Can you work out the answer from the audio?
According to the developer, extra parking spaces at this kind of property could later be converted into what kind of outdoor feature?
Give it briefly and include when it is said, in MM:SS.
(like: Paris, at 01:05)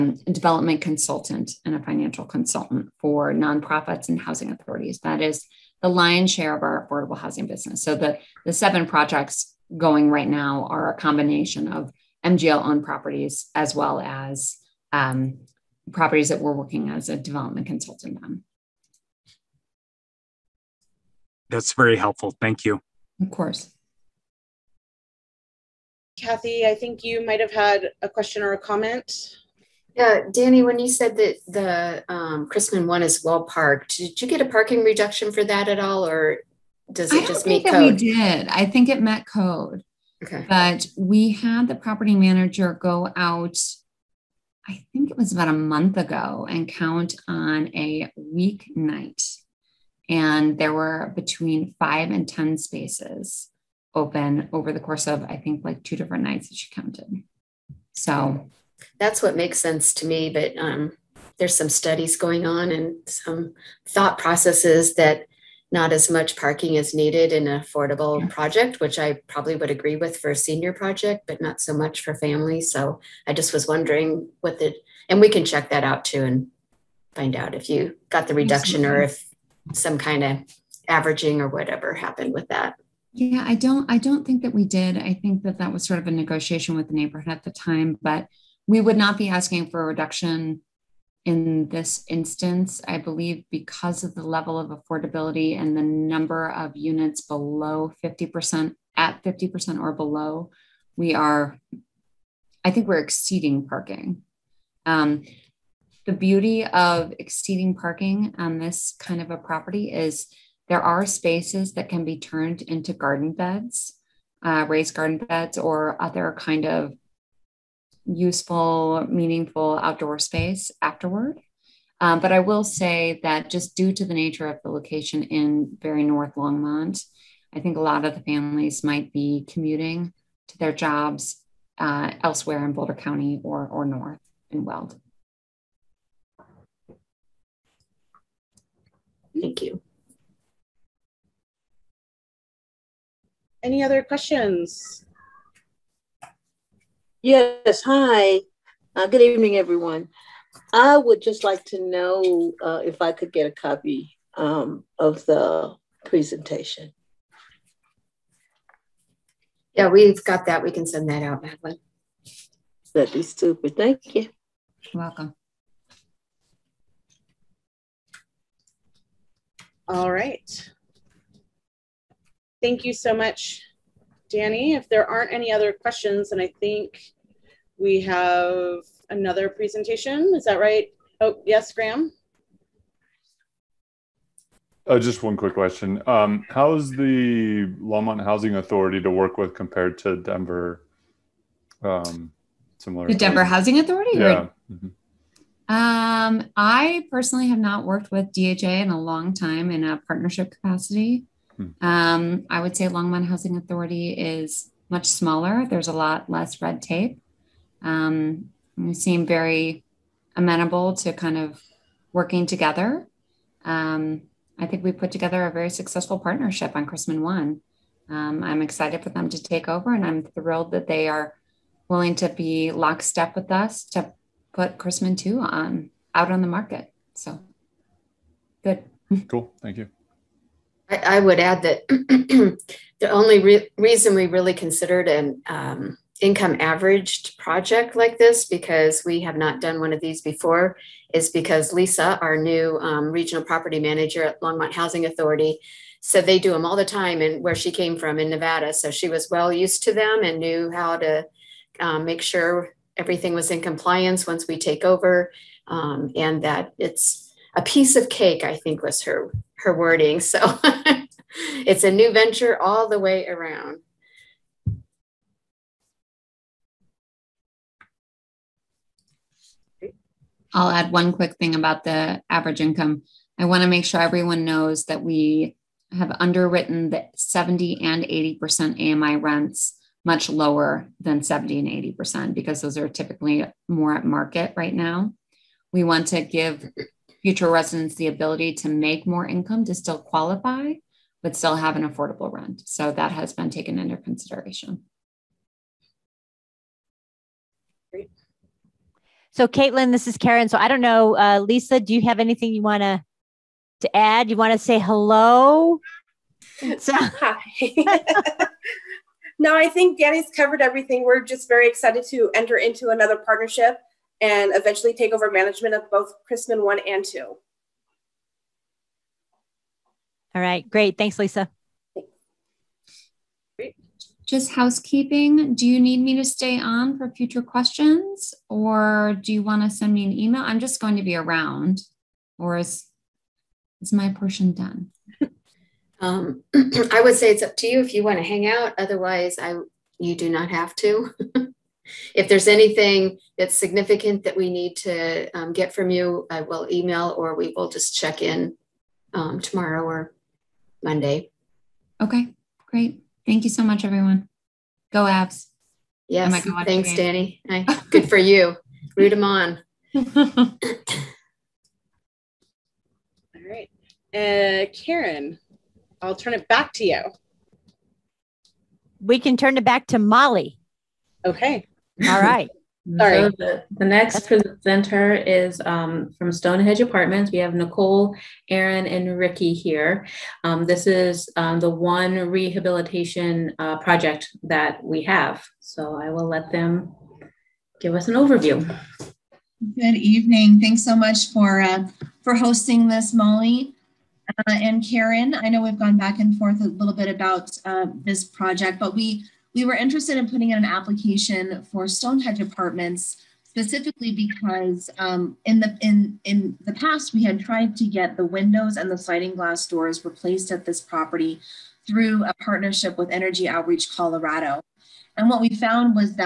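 raised garden beds, at 01:54.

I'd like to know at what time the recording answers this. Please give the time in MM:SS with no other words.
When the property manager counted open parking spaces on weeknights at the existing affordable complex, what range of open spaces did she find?
00:51.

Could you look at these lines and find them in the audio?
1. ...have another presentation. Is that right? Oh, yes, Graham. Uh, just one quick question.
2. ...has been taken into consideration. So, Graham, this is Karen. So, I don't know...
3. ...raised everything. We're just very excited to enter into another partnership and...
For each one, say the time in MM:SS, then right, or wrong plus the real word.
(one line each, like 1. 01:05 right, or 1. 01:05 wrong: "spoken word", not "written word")
1. 02:58 right
2. 04:53 wrong: "Caitlin", not "Graham"
3. 05:10 wrong: "covered", not "raised".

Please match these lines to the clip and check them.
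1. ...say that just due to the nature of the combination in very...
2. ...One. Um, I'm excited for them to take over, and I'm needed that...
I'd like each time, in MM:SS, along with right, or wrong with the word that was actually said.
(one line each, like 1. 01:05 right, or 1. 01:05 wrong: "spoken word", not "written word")
1. 02:02 wrong: "location", not "combination"
2. 03:37 wrong: "thrilled", not "needed".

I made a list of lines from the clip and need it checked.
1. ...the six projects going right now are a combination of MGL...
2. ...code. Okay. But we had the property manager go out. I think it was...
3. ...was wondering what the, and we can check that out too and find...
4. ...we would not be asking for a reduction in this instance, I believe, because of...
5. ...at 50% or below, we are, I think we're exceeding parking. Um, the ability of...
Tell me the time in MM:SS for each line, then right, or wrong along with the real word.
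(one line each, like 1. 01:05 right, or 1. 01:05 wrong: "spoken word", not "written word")
1. 00:08 wrong: "seven", not "six"
2. 00:39 right
3. 01:13 right
4. 01:28 right
5. 01:38 wrong: "beauty", not "ability".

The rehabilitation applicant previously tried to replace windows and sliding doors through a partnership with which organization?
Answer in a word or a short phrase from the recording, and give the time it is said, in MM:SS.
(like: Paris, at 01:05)
Energy Outreach Colorado, at 06:53.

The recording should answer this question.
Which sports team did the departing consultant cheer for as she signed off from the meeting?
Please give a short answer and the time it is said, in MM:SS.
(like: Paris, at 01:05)
Avs, at 05:55.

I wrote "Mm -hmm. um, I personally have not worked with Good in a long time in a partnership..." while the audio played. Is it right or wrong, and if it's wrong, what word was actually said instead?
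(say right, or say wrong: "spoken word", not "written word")
wrong: "DHA", not "Good".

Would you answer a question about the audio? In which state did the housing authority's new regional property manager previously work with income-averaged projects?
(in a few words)
Nevada.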